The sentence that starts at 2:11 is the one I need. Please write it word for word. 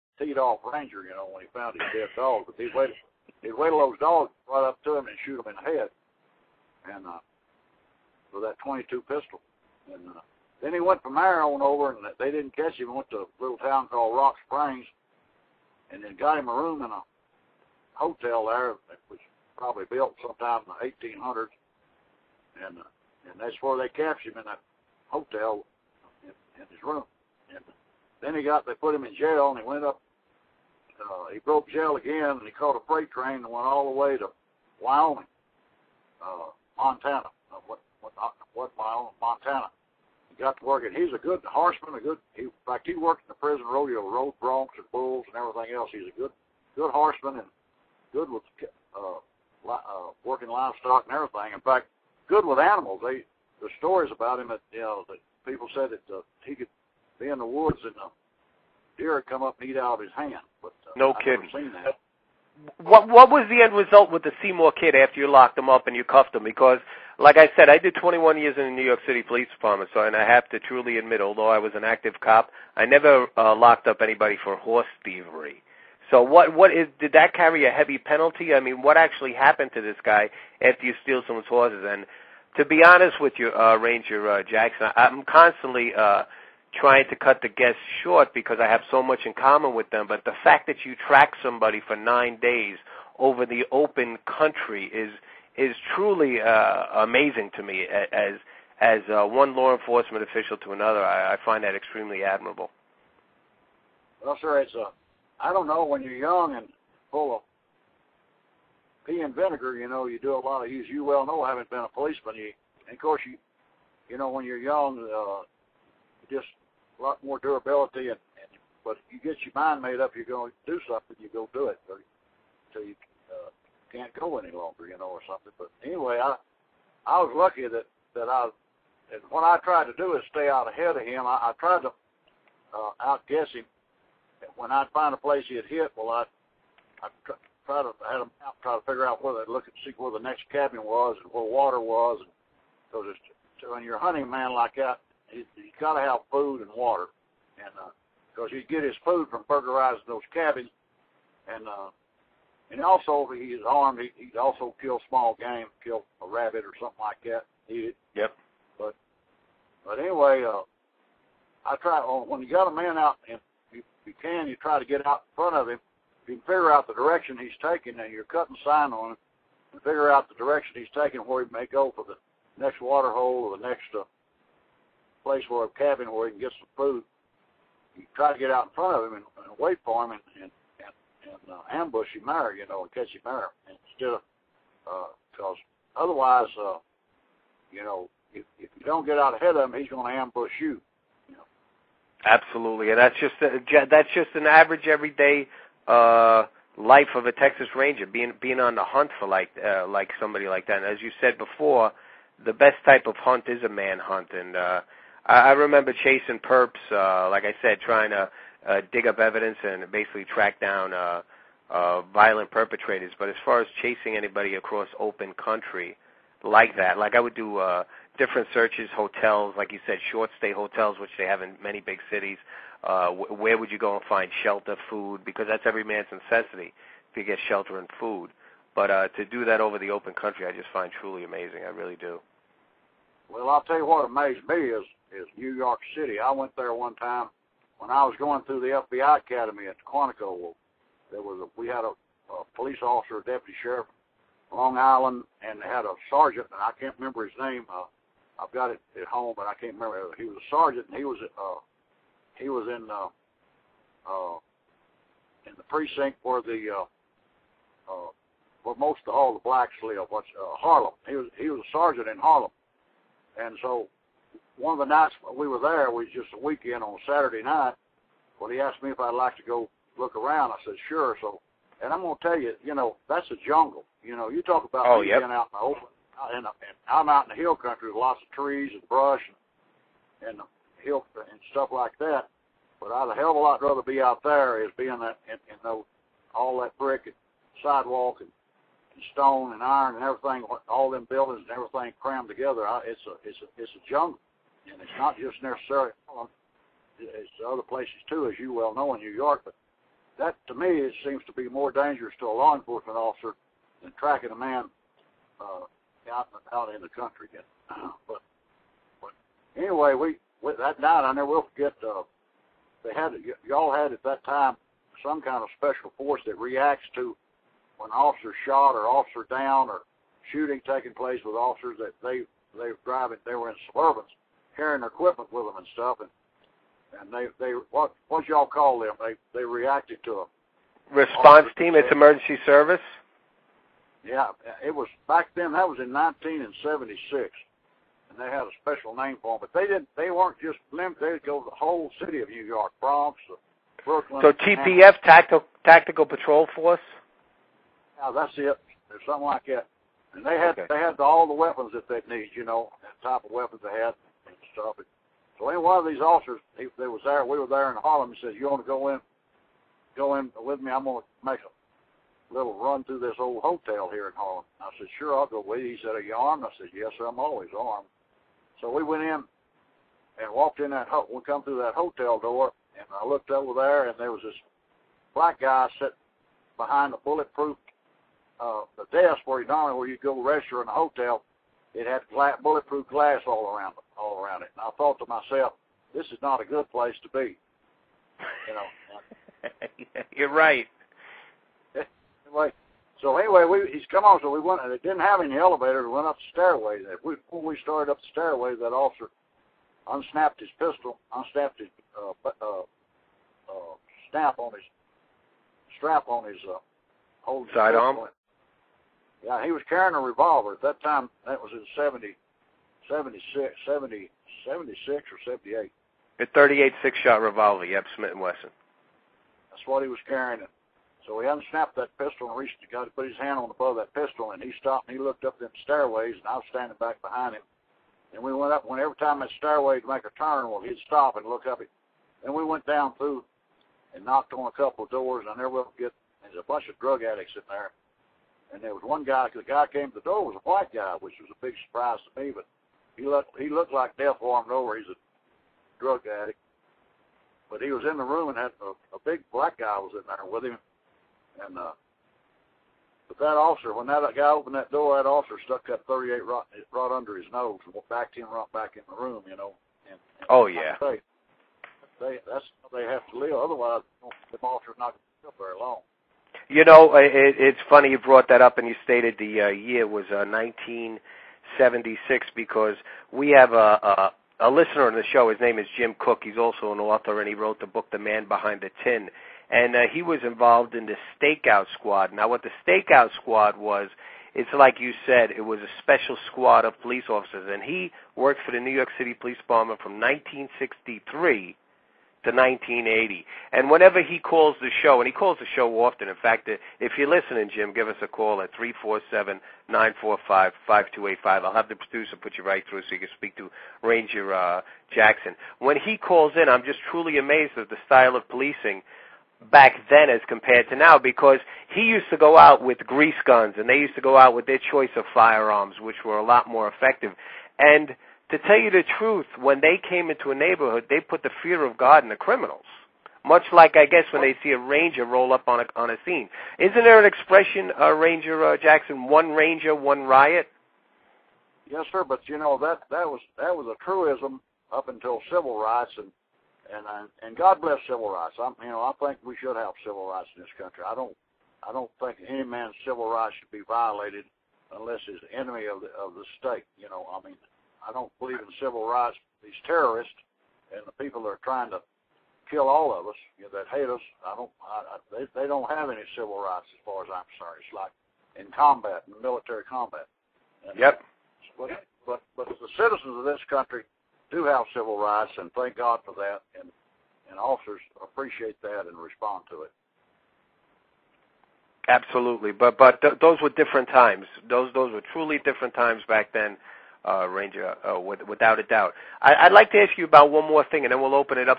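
I, I tried to uh, outguess him.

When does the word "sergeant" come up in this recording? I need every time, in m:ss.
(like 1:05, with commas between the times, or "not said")
4:06, 4:10, 4:21.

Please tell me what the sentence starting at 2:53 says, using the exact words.
Uh, place where a cabin where he can get some food.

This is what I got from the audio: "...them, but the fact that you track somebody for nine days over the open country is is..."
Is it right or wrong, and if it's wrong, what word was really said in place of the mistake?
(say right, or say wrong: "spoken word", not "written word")
right.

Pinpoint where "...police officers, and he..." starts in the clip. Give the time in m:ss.
8:06.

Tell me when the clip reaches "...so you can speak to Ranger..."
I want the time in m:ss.
8:22.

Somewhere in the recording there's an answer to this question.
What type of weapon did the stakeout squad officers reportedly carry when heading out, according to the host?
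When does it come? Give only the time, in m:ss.
8:32.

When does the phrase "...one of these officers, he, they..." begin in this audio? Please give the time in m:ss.
5:55.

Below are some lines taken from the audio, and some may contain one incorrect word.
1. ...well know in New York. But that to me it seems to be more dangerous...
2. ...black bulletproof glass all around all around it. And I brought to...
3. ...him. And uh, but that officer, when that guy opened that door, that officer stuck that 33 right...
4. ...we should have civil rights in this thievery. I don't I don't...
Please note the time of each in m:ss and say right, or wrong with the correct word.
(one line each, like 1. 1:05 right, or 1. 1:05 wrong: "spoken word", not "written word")
1. 4:58 right
2. 6:22 wrong: "thought", not "brought"
3. 7:30 wrong: "38", not "33"
4. 8:59 wrong: "country", not "thievery".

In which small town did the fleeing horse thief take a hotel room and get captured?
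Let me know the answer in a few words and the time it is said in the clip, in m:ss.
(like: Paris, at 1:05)
Rock Springs, at 0:14.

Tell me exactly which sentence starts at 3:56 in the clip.
I went there one time when I was going through the FBI academy at Quantico.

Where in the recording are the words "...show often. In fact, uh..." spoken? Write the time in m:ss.
8:15.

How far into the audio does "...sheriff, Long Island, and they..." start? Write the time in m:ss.
4:03.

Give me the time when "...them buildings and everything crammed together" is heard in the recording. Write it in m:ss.
4:50.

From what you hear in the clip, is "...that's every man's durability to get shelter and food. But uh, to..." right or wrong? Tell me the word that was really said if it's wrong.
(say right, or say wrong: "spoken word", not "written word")
wrong: "necessity", not "durability".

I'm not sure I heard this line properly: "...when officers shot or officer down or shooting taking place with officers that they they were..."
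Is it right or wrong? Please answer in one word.
right.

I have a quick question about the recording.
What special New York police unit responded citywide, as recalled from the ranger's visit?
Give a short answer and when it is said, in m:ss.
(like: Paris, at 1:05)
Tactical Patrol Force, at 5:45.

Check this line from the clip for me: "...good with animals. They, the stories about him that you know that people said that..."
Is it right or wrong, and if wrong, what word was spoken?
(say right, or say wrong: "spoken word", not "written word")
right.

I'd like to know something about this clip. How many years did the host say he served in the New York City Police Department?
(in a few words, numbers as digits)
21.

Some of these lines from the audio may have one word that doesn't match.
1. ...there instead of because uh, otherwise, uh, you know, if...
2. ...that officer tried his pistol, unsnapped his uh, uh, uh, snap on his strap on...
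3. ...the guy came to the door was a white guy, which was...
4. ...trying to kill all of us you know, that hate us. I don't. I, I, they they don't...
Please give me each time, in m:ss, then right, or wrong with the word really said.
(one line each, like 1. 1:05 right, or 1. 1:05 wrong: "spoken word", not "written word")
1. 3:03 right
2. 6:38 wrong: "unsnapped", not "tried"
3. 7:19 right
4. 9:11 right.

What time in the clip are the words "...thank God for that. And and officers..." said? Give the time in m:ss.
9:25.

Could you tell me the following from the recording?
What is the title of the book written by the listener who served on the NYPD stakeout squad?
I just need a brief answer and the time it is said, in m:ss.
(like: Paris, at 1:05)
The Man Behind the Tin, at 7:57.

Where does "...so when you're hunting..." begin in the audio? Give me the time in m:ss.
2:23.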